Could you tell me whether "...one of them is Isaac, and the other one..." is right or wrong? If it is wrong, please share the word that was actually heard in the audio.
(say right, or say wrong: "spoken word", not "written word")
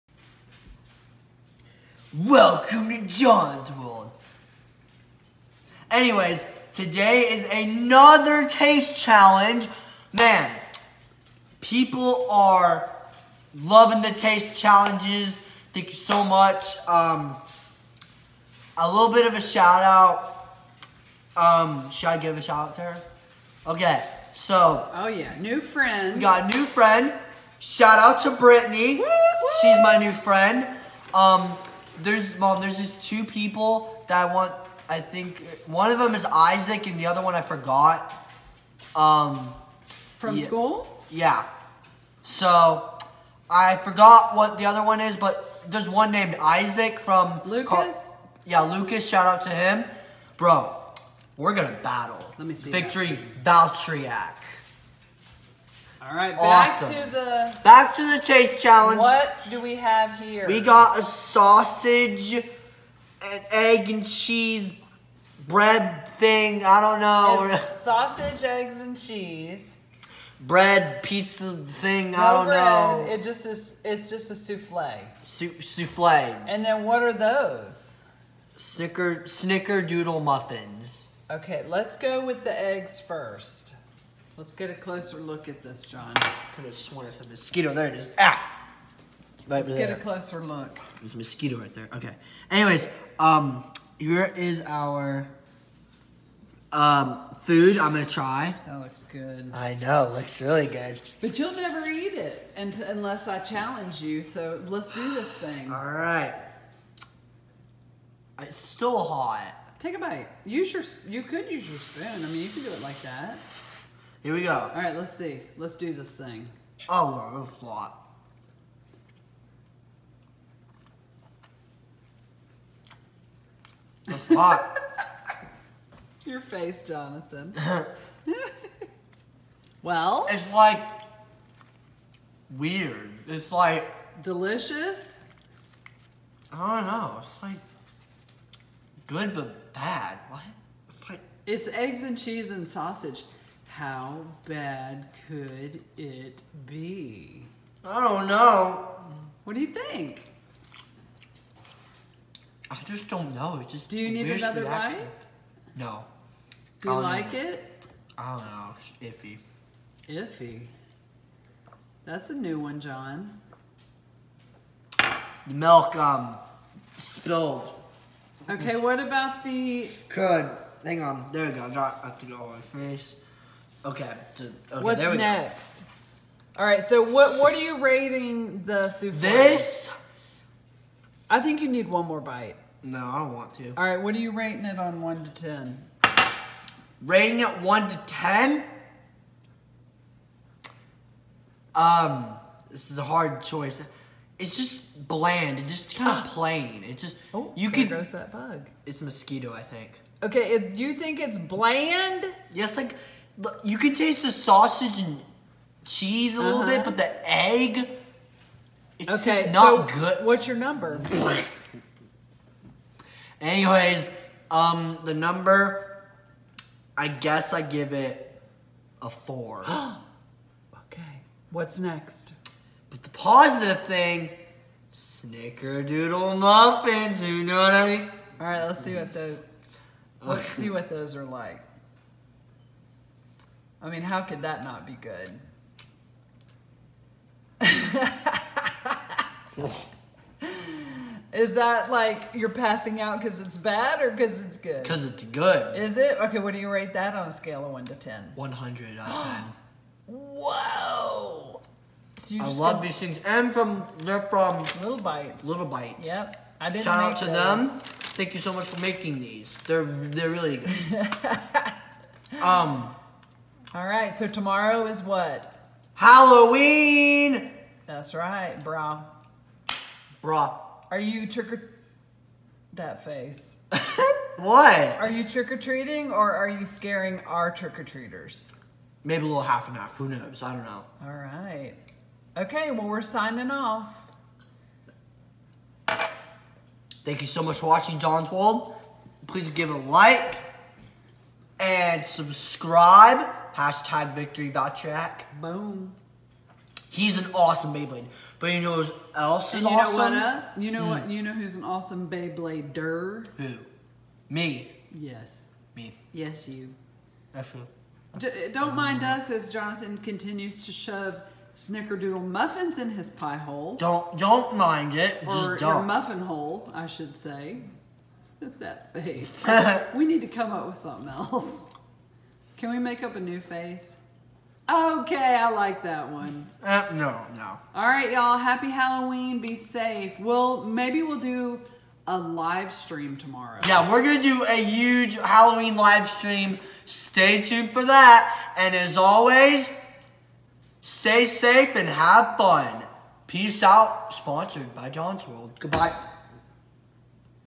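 right.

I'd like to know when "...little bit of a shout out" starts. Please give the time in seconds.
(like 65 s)
18 s.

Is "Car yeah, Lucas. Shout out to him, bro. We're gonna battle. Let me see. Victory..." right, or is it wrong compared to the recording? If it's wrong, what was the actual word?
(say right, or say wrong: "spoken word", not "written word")
right.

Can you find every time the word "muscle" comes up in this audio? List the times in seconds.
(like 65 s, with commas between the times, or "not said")
not said.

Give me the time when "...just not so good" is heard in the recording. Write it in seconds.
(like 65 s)
209 s.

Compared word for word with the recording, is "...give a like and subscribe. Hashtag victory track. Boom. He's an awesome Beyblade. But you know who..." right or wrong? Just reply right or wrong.
right.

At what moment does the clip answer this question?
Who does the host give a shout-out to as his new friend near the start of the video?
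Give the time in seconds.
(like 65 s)
28 s.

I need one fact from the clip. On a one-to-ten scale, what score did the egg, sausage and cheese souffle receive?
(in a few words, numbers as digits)
4.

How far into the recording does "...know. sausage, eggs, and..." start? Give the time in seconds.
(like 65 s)
66 s.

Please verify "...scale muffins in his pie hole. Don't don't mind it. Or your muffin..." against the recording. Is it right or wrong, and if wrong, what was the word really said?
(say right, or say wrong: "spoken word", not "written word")
wrong: "snickerdoodle", not "scale".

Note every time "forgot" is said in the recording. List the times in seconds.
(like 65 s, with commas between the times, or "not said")
37 s, 43 s.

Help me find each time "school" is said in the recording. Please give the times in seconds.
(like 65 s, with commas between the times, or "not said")
40 s.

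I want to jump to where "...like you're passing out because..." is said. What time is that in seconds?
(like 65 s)
241 s.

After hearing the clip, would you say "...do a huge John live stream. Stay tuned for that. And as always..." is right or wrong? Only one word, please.
wrong.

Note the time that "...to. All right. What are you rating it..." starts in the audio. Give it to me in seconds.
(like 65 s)
183 s.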